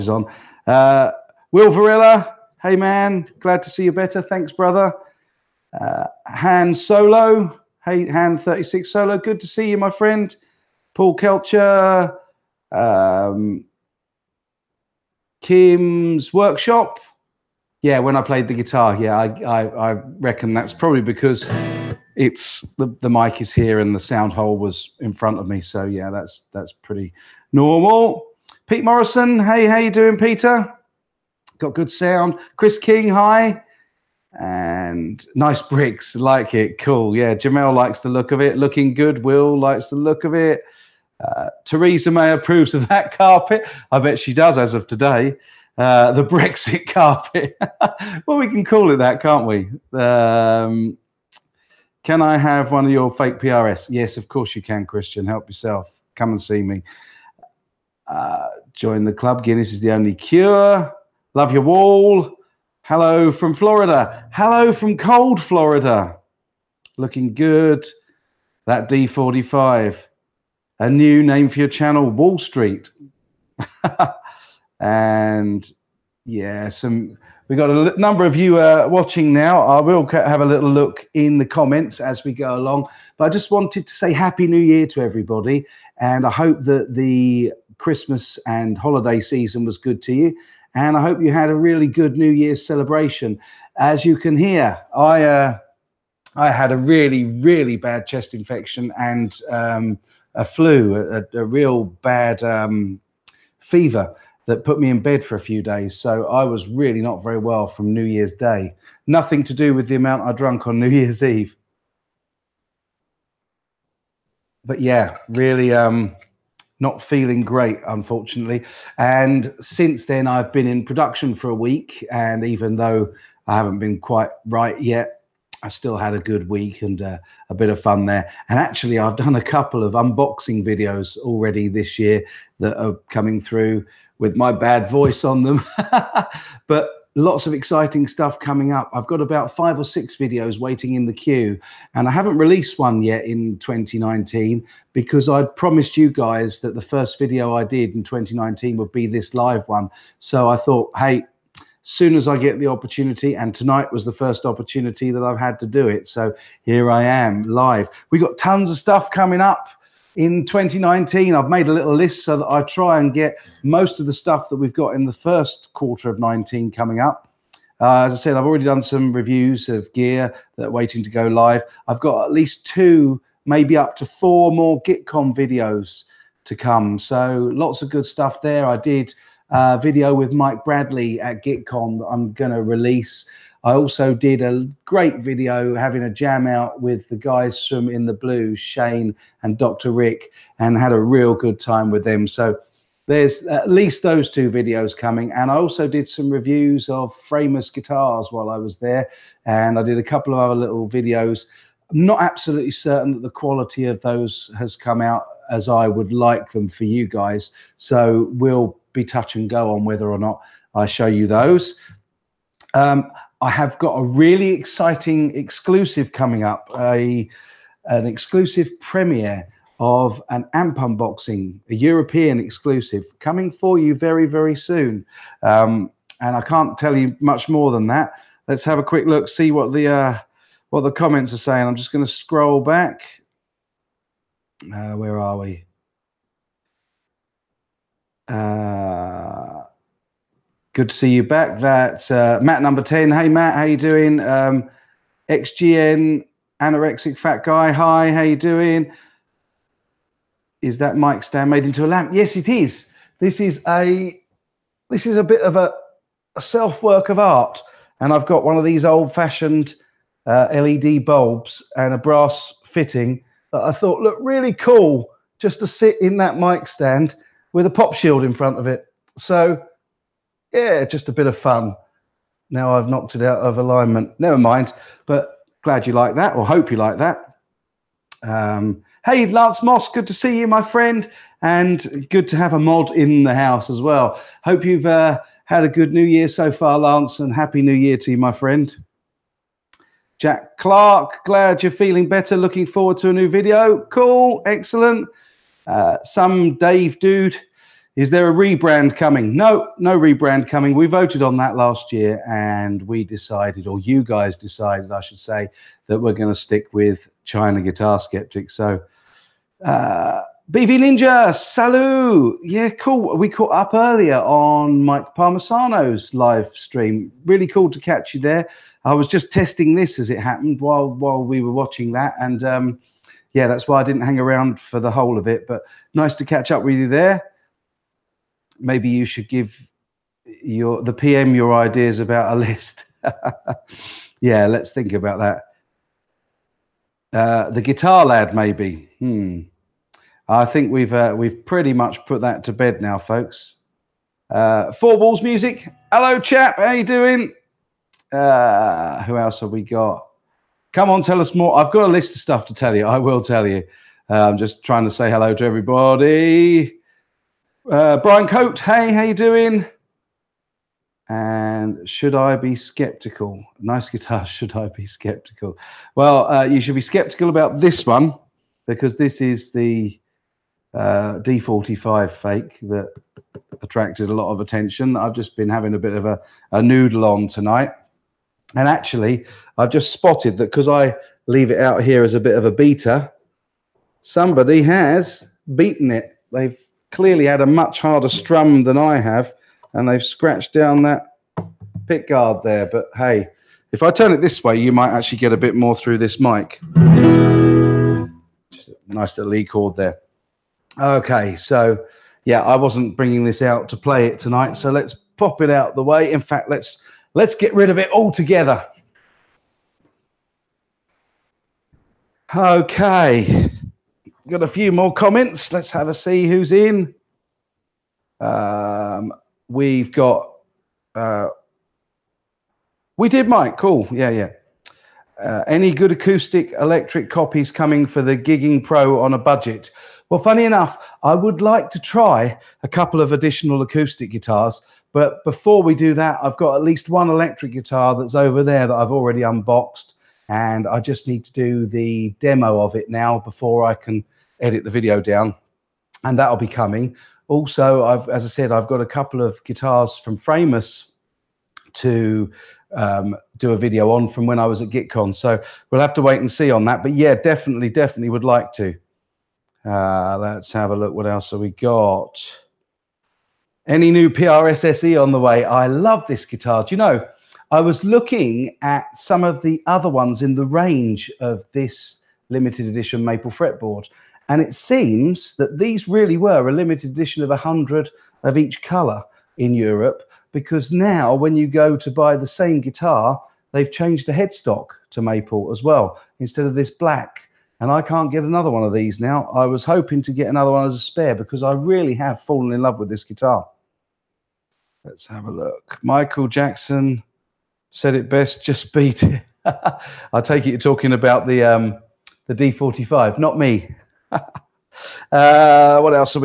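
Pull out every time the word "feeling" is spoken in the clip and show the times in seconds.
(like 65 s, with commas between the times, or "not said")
117 s, 291 s.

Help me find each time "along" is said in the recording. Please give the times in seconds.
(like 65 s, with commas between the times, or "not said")
82 s.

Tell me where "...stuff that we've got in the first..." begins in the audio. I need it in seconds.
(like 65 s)
164 s.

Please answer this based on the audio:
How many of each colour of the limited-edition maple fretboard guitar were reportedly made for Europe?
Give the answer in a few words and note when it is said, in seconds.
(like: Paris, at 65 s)
100, at 477 s.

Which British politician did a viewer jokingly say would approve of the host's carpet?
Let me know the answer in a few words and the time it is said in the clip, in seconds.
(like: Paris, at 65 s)
Theresa May, at 41 s.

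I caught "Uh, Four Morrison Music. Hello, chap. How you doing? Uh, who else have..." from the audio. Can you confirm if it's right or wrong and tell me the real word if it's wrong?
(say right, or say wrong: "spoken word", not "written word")
wrong: "Walls", not "Morrison".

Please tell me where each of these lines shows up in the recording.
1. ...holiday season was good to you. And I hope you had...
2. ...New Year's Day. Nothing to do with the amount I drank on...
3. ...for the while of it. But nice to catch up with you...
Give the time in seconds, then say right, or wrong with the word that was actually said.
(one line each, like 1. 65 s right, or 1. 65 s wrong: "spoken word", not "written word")
1. 88 s right
2. 107 s right
3. 324 s wrong: "whole", not "while".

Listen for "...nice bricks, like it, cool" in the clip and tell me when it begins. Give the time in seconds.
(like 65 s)
35 s.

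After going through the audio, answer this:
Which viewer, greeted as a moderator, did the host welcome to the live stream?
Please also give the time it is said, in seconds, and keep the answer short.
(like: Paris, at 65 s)
Lance Moss, at 279 s.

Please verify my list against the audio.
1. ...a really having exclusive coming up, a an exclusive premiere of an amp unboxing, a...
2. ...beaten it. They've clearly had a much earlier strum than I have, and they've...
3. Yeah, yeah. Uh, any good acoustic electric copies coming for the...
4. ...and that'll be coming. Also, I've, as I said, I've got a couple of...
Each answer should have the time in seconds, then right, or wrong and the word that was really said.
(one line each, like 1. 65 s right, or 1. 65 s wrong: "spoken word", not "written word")
1. 213 s wrong: "exciting", not "having"
2. 385 s wrong: "harder", not "earlier"
3. 423 s right
4. 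446 s right.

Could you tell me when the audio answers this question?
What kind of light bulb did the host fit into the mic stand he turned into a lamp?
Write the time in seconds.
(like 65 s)
260 s.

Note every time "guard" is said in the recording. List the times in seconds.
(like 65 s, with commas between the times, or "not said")
392 s.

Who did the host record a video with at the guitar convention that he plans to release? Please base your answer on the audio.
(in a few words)
Mike Bradley.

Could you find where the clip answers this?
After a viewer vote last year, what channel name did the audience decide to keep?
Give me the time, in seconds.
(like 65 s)
307 s.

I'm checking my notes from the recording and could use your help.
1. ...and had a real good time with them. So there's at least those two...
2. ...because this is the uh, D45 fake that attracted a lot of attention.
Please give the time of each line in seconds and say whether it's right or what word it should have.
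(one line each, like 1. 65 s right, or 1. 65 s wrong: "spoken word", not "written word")
1. 190 s right
2. 368 s right.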